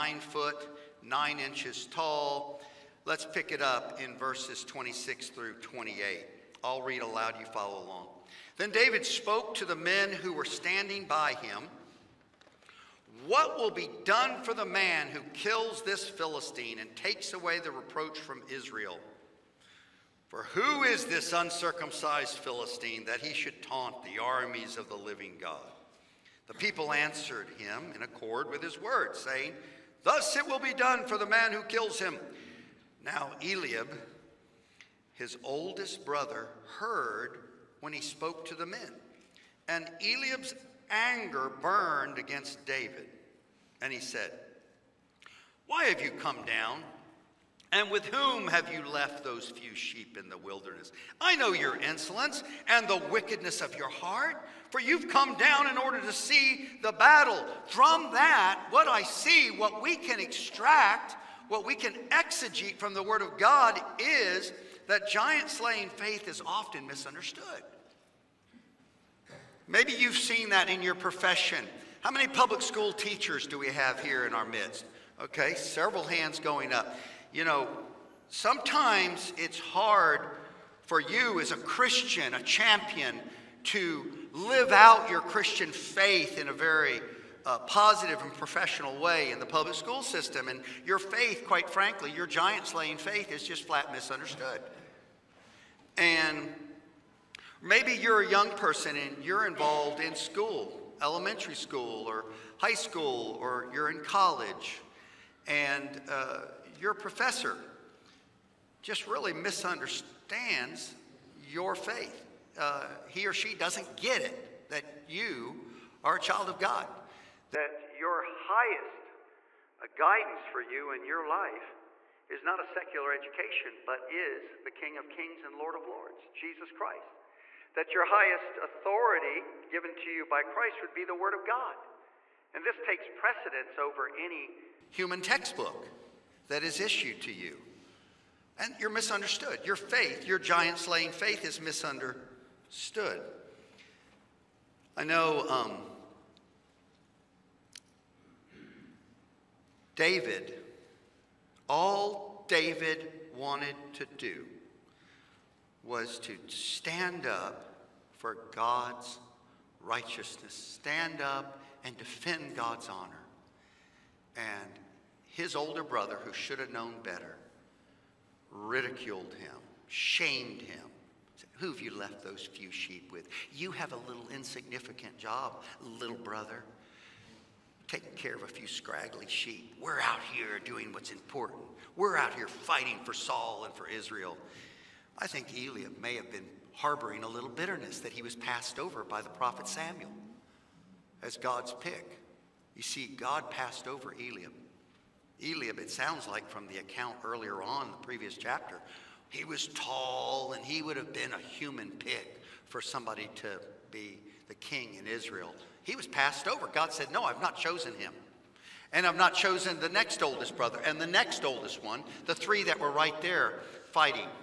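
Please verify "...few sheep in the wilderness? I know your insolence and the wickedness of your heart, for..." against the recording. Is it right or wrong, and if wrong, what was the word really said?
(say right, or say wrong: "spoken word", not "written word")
right.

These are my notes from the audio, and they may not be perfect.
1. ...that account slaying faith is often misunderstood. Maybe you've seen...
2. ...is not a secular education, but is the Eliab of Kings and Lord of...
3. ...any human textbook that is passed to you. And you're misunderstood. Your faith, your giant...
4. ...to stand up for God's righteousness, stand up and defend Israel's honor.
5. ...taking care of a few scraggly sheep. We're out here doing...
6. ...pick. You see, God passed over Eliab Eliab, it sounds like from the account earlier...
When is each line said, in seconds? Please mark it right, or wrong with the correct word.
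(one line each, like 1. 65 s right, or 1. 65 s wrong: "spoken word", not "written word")
1. 64 s wrong: "giant", not "account"
2. 122 s wrong: "King", not "Eliab"
3. 134 s wrong: "issued", not "passed"
4. 156 s wrong: "God", not "Israel"
5. 177 s right
6. 191 s right.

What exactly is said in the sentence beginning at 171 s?
Said, who have you left those few sheep with?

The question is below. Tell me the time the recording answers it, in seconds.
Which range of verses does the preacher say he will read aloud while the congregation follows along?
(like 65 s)
4 s.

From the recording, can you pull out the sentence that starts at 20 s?
For who is this uncircumcised Philistine that he should taunt the armies of the living God?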